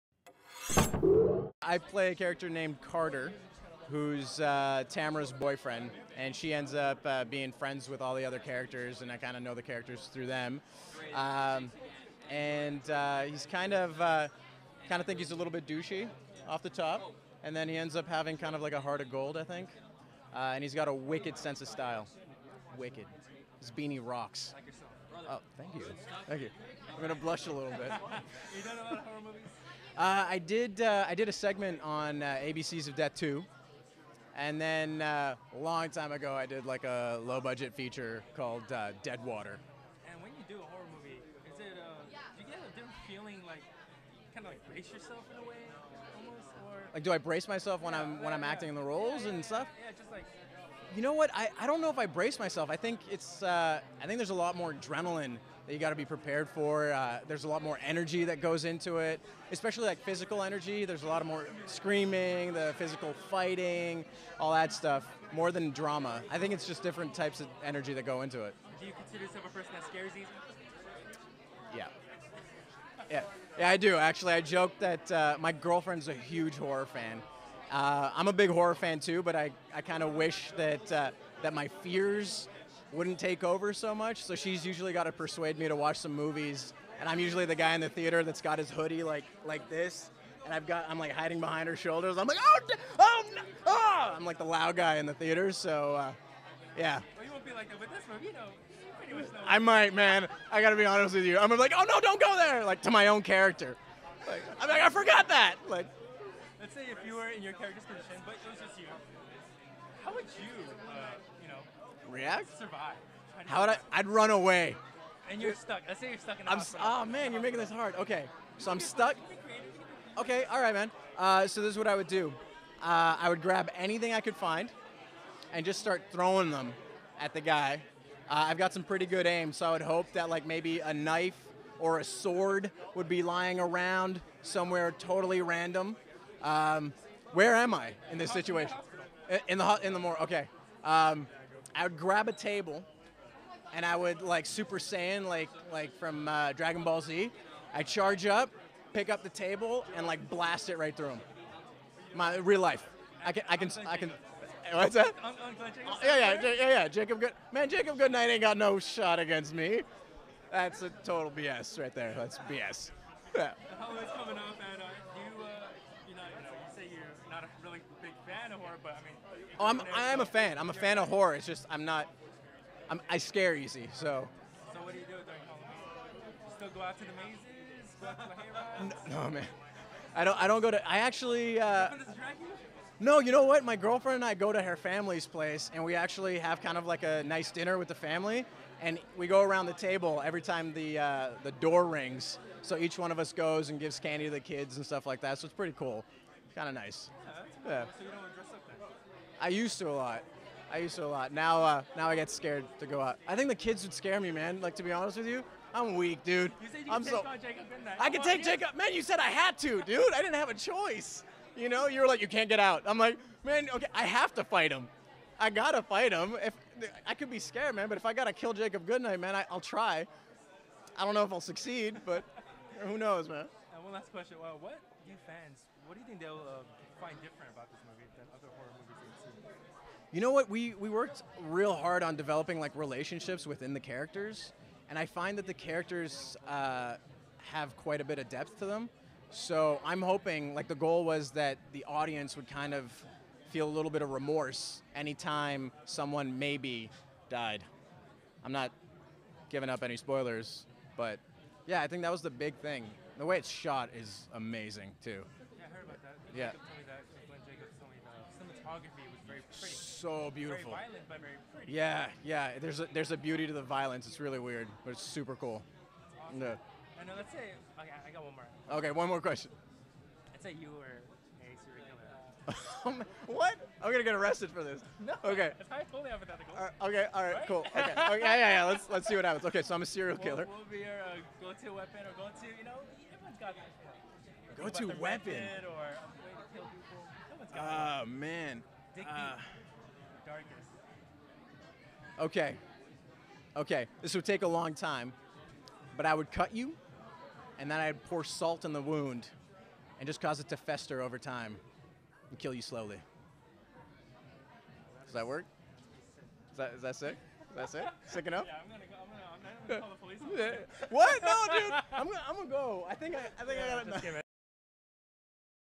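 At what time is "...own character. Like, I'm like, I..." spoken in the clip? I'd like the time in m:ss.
1:43.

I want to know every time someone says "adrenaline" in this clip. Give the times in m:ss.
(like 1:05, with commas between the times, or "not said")
0:54.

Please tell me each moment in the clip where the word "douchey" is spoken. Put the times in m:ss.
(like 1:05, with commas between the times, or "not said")
0:15.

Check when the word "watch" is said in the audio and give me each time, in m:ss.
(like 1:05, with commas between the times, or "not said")
1:25.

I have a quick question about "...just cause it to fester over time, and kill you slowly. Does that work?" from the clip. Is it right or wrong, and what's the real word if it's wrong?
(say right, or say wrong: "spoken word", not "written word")
right.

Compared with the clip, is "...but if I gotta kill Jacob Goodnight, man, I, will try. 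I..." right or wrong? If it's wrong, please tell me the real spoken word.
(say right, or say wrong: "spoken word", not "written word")
right.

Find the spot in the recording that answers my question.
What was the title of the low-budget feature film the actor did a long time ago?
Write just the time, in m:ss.
0:39.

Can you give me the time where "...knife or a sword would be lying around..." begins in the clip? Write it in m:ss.
2:10.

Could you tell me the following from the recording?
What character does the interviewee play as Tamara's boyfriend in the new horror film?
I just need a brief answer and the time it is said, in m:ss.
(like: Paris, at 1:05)
Carter, at 0:02.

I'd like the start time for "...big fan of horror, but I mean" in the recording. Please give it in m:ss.
2:48.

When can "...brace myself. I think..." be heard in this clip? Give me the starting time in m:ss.
0:52.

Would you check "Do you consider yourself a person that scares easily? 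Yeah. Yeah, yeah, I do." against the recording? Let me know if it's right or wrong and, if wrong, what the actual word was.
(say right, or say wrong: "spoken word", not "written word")
right.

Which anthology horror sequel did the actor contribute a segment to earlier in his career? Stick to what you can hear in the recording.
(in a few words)
ABCs of Death 2.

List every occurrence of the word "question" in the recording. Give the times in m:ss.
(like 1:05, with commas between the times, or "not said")
3:44, 4:29.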